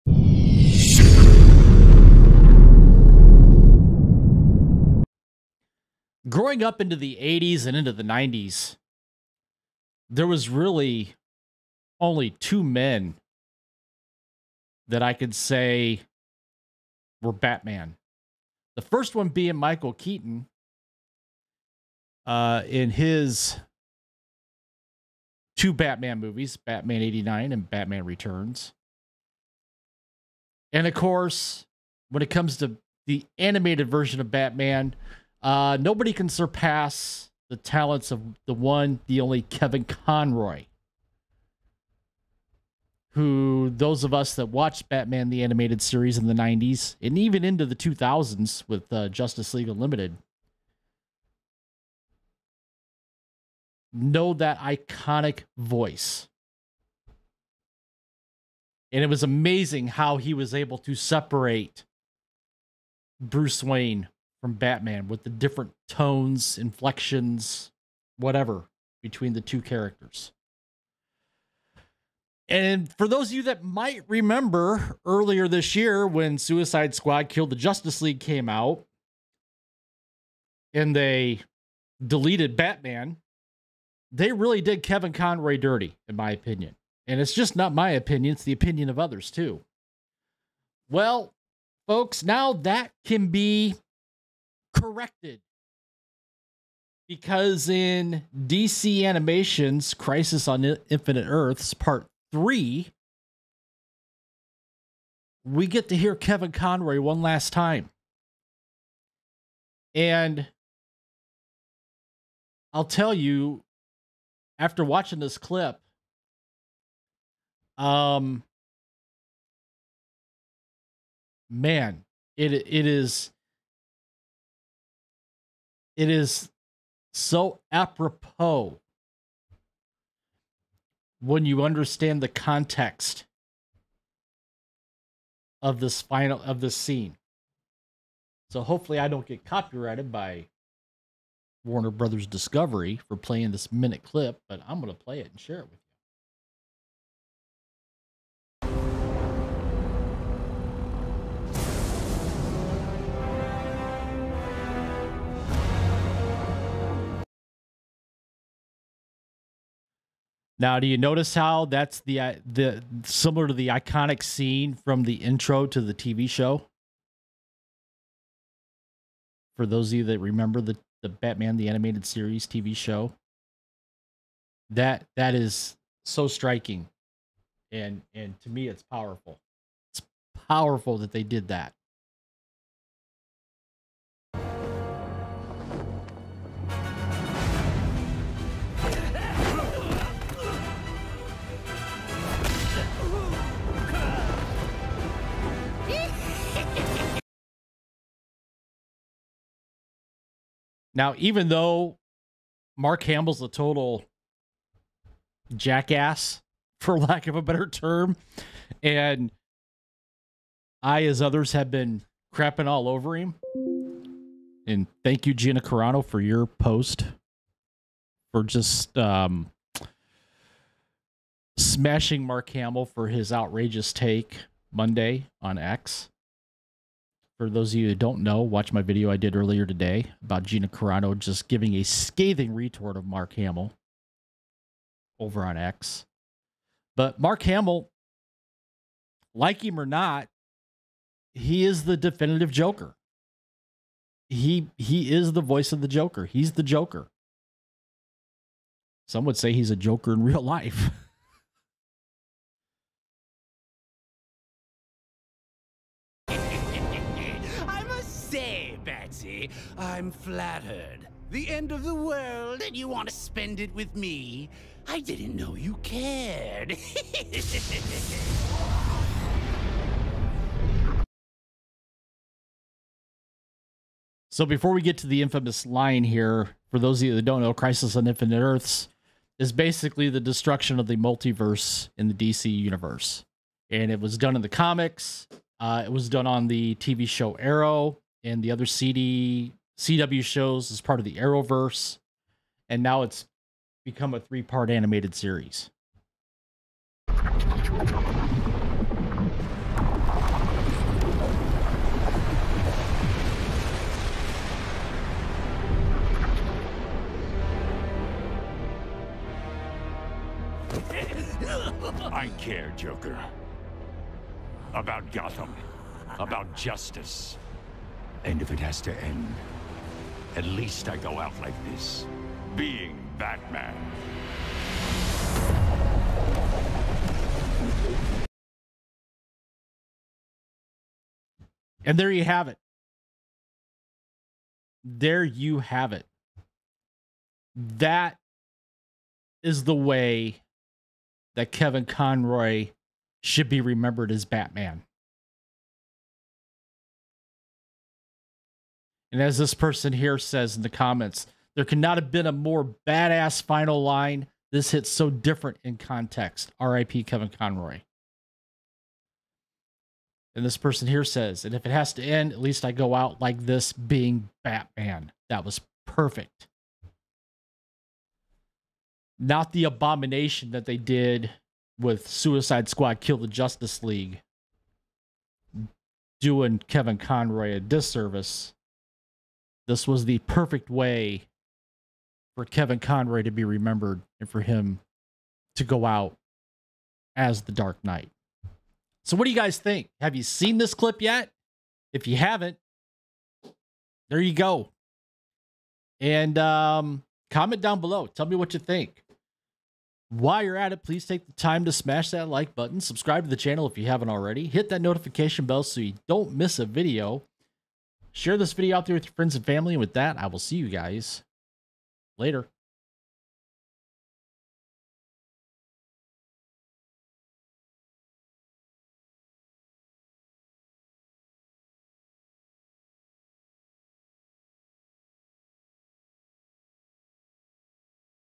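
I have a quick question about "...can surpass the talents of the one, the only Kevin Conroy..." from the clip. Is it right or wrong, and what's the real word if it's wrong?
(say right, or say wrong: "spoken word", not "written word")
right.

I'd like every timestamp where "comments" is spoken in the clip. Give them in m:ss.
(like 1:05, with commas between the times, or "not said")
5:50, 6:37.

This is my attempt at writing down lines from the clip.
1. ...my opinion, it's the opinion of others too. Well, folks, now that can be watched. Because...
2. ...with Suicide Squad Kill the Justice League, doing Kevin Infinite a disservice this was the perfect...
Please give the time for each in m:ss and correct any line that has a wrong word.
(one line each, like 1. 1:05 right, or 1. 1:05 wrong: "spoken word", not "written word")
1. 1:27 wrong: "corrected", not "watched"
2. 6:11 wrong: "Conroy", not "Infinite".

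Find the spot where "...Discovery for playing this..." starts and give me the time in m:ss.
2:22.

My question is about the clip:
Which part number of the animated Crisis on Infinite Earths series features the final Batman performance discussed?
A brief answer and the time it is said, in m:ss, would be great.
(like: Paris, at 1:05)
3, at 1:41.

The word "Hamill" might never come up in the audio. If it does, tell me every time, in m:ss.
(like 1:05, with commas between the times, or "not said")
3:23, 3:42, 3:53, 3:57.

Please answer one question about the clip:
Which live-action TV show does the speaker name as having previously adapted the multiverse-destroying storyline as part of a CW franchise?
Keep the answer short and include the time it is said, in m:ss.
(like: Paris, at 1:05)
Arrow, at 4:47.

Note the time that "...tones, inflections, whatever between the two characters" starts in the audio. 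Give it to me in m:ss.
1:05.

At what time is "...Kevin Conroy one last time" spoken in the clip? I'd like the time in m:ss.
1:46.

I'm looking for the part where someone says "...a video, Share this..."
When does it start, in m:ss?
6:46.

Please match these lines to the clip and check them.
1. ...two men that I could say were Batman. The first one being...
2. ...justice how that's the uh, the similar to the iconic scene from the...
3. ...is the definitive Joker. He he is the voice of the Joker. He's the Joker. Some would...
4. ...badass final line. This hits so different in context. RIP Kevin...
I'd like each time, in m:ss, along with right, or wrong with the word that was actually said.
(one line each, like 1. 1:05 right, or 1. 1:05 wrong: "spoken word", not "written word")
1. 0:12 right
2. 2:40 wrong: "notice", not "justice"
3. 4:01 right
4. 5:52 right.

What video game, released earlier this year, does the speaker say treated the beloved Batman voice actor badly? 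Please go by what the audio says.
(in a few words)
Suicide Squad Killed the Justice League.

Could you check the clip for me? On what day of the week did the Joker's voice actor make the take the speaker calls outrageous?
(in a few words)
Monday.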